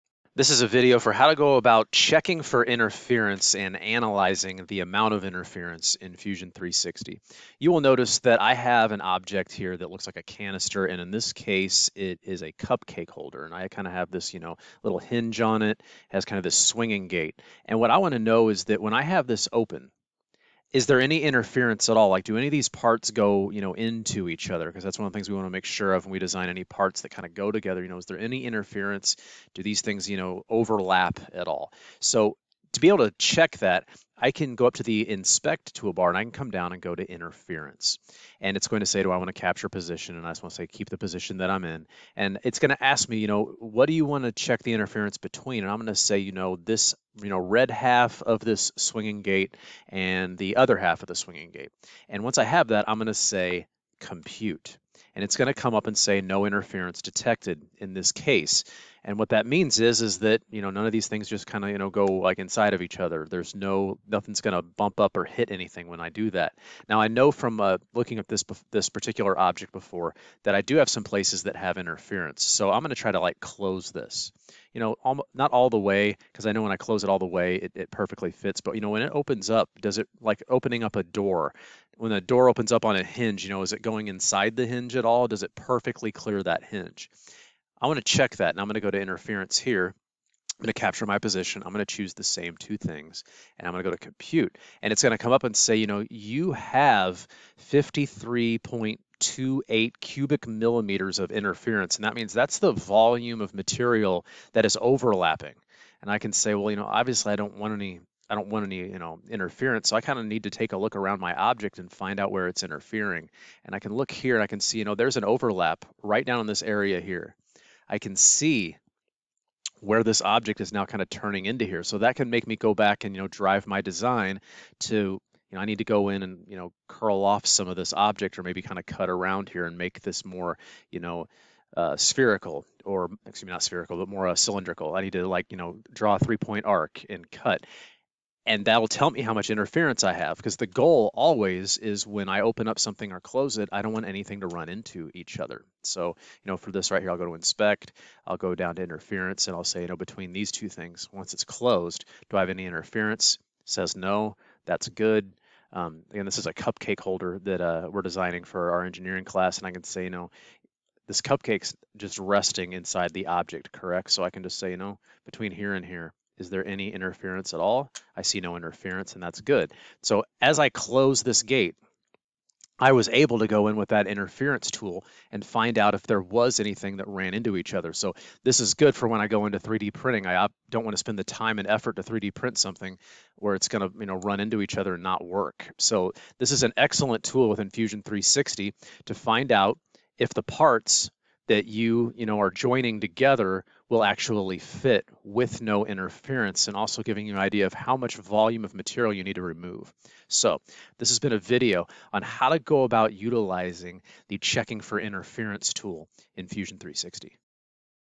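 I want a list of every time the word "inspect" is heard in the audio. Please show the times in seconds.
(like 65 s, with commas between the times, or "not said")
35 s, 147 s.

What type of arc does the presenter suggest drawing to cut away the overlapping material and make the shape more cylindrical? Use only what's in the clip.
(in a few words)
three point arc.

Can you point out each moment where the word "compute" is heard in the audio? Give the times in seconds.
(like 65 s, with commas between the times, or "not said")
53 s, 93 s.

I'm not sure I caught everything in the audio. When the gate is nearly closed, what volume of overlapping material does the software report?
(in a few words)
53.28 cubic millimeters.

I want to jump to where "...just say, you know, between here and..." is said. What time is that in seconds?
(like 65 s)
164 s.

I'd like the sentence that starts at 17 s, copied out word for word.
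And what I want to know is that when I have this open, is there any interference at all?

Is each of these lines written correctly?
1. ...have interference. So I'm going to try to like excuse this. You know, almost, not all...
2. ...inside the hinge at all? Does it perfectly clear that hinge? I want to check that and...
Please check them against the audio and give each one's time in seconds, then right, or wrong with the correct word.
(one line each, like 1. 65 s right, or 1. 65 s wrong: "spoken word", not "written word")
1. 71 s wrong: "close", not "excuse"
2. 84 s right.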